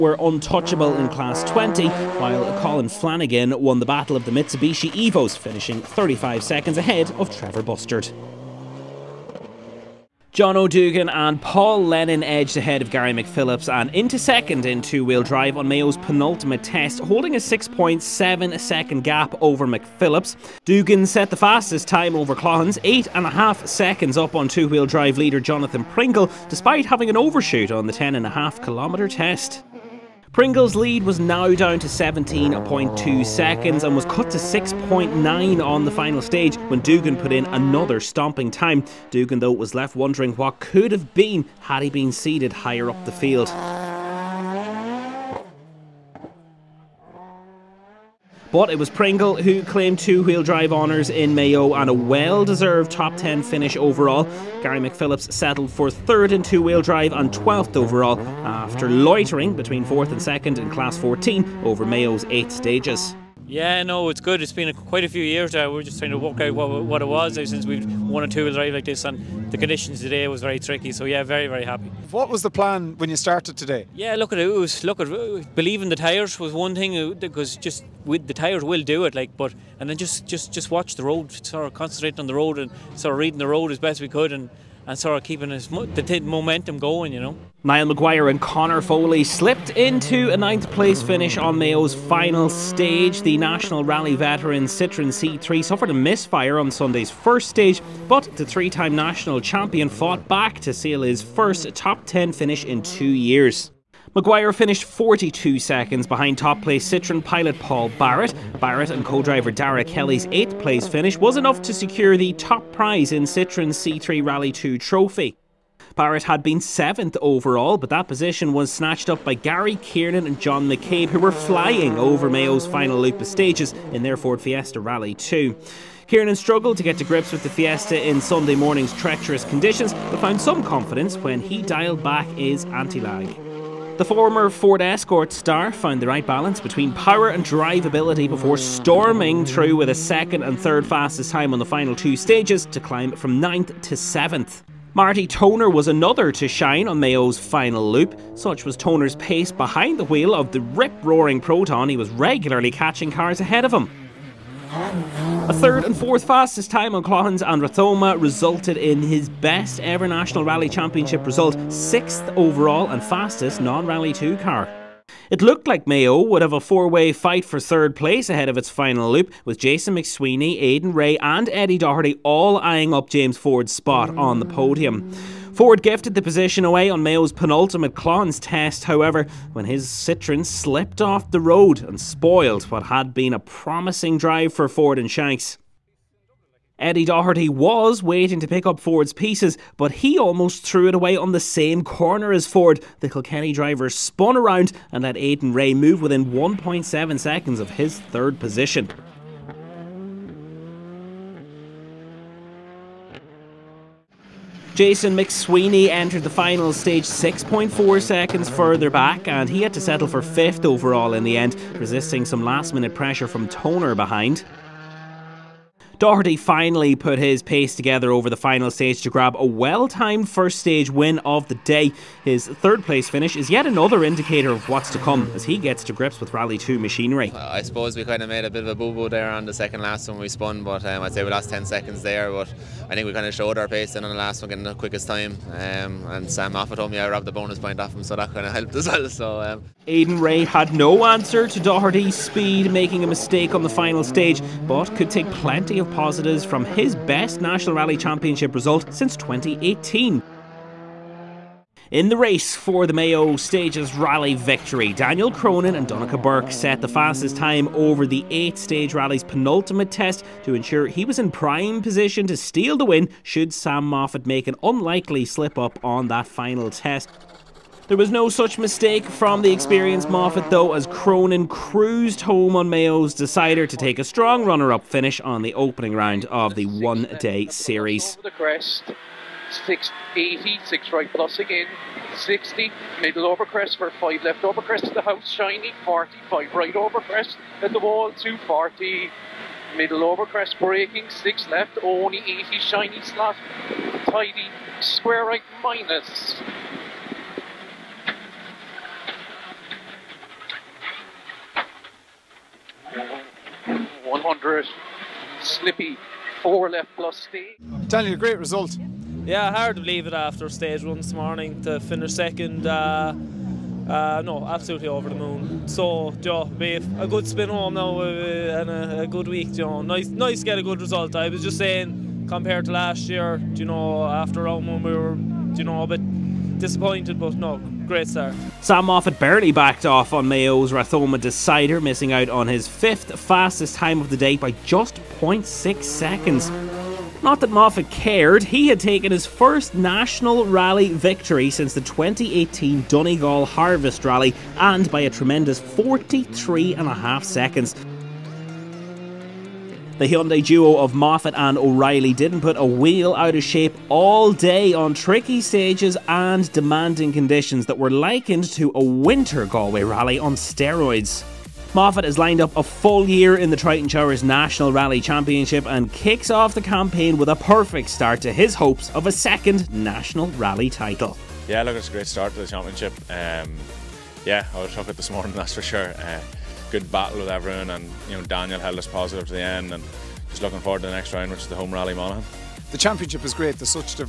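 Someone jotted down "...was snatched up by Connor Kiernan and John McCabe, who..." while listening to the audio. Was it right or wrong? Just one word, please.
wrong.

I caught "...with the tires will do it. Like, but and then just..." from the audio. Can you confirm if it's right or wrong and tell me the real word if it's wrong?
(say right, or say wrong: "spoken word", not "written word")
right.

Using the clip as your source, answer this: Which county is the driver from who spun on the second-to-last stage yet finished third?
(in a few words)
Kilkenny.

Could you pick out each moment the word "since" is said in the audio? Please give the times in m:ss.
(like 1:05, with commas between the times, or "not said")
1:07, 4:08, 5:41.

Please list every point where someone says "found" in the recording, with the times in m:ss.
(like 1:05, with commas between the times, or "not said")
2:10, 2:15.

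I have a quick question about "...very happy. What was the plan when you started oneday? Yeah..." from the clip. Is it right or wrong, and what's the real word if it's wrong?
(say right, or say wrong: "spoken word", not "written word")
wrong: "today", not "oneday".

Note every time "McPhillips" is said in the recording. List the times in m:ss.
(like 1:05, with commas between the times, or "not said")
0:13, 0:19, 0:54.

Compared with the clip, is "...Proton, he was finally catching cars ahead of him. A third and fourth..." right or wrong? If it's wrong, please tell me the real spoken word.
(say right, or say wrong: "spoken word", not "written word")
wrong: "regularly", not "finally".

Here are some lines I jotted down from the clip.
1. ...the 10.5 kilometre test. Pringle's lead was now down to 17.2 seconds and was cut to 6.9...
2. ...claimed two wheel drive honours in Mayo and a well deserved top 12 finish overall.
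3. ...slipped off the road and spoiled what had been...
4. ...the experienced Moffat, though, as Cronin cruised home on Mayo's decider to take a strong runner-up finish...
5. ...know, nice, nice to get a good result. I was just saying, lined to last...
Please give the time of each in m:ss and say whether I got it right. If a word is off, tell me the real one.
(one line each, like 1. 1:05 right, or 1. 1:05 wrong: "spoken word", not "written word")
1. 0:27 right
2. 0:49 wrong: "10", not "12"
3. 3:00 right
4. 4:29 right
5. 5:19 wrong: "compared", not "lined".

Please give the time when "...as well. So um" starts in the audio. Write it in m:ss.
3:58.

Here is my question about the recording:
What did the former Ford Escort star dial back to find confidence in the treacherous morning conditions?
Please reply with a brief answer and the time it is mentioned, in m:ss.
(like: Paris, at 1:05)
anti-lag, at 2:12.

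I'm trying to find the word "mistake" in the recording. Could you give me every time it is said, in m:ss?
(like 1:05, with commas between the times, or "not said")
4:03, 4:28.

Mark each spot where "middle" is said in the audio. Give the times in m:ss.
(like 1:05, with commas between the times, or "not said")
4:43, 4:49.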